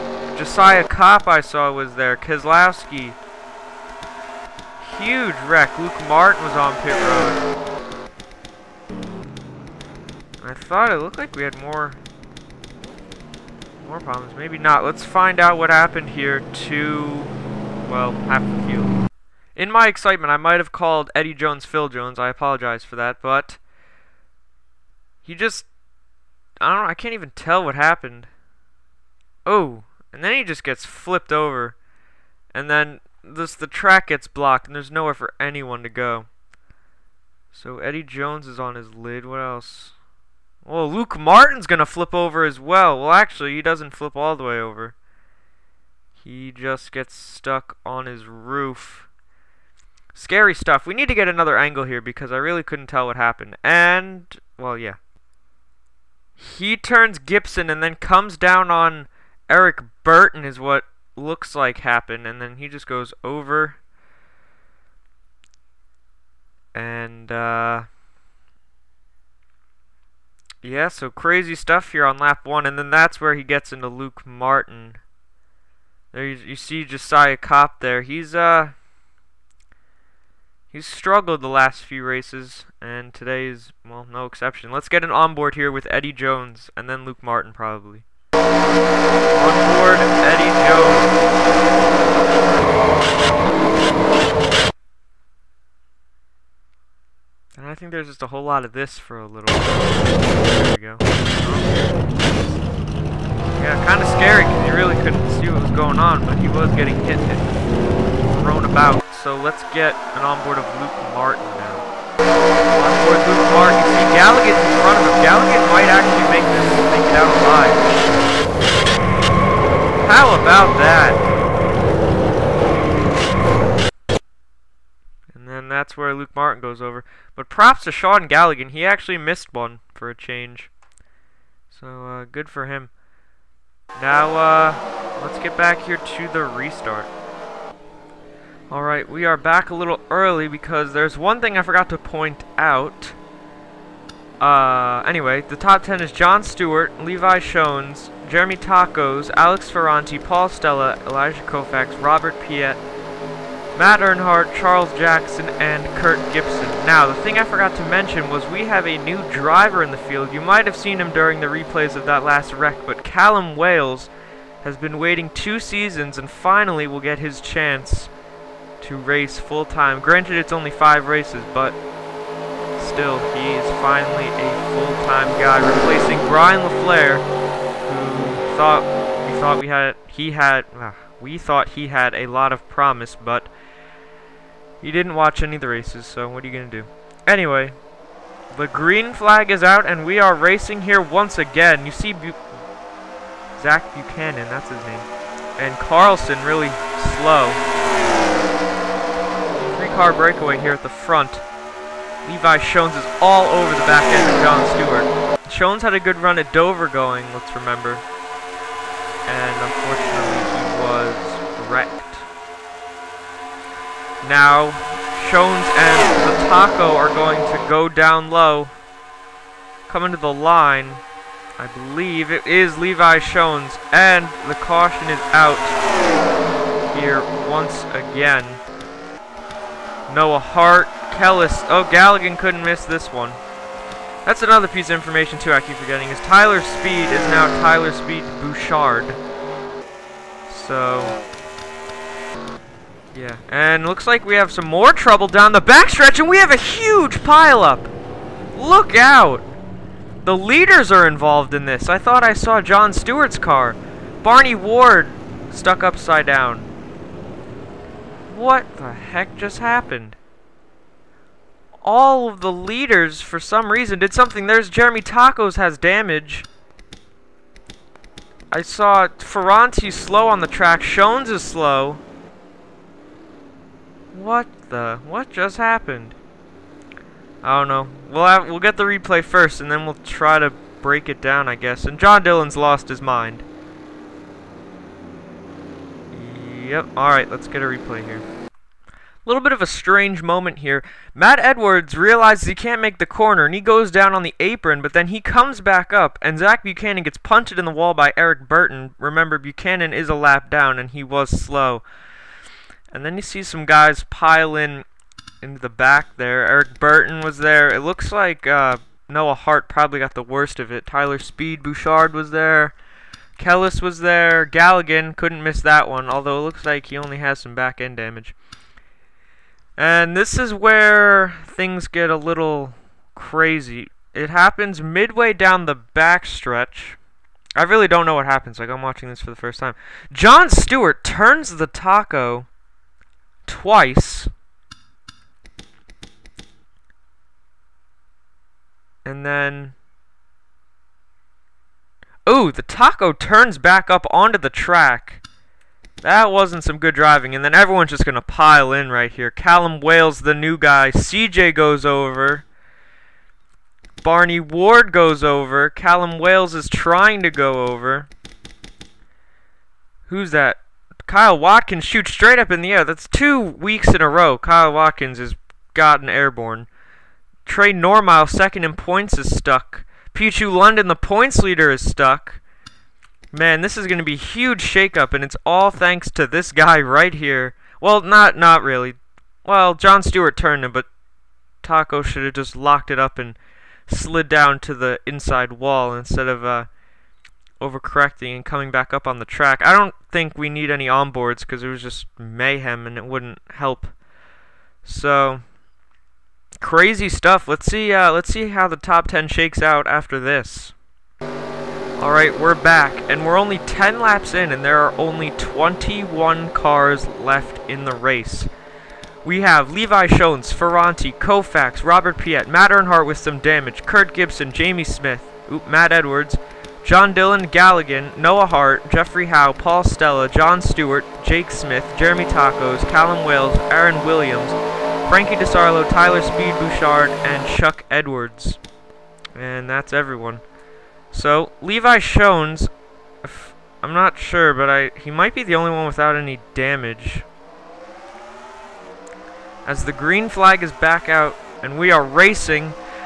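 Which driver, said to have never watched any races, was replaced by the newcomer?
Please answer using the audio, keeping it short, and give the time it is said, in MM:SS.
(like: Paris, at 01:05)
Brian LaFleur, at 02:55.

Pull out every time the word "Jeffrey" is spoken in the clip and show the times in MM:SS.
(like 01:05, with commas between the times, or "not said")
06:58.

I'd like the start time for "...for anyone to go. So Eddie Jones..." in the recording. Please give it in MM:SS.
00:35.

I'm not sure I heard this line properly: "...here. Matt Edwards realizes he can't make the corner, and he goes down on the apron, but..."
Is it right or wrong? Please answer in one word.
right.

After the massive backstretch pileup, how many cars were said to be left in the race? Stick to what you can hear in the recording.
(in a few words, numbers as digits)
21.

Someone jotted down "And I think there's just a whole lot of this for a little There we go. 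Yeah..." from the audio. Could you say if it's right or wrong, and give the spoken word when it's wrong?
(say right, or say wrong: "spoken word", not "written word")
right.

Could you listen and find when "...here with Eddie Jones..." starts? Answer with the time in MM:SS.
01:25.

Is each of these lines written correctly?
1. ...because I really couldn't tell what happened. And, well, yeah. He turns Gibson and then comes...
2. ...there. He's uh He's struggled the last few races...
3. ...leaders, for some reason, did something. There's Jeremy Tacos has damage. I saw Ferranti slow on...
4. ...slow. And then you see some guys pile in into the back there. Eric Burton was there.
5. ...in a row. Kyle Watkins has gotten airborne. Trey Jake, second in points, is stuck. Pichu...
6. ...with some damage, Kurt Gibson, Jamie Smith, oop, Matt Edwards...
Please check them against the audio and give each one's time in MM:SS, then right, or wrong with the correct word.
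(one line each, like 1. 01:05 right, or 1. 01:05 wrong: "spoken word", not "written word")
1. 00:51 right
2. 01:17 right
3. 04:22 right
4. 05:01 right
5. 06:03 wrong: "Normile", not "Jake"
6. 06:53 right.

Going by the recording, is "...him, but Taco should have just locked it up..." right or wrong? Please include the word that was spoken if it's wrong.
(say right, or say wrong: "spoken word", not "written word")
right.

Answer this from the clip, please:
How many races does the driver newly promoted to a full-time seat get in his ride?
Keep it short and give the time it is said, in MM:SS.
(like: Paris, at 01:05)
5, at 02:50.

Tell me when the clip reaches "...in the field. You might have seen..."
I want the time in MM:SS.
02:39.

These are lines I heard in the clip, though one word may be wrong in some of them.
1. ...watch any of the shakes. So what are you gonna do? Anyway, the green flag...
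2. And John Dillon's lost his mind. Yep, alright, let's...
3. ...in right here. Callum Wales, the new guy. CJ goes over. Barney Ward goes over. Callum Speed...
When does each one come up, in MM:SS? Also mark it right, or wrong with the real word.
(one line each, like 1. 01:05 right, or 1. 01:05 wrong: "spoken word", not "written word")
1. 03:05 wrong: "races", not "shakes"
2. 04:41 right
3. 05:48 wrong: "Wales", not "Speed".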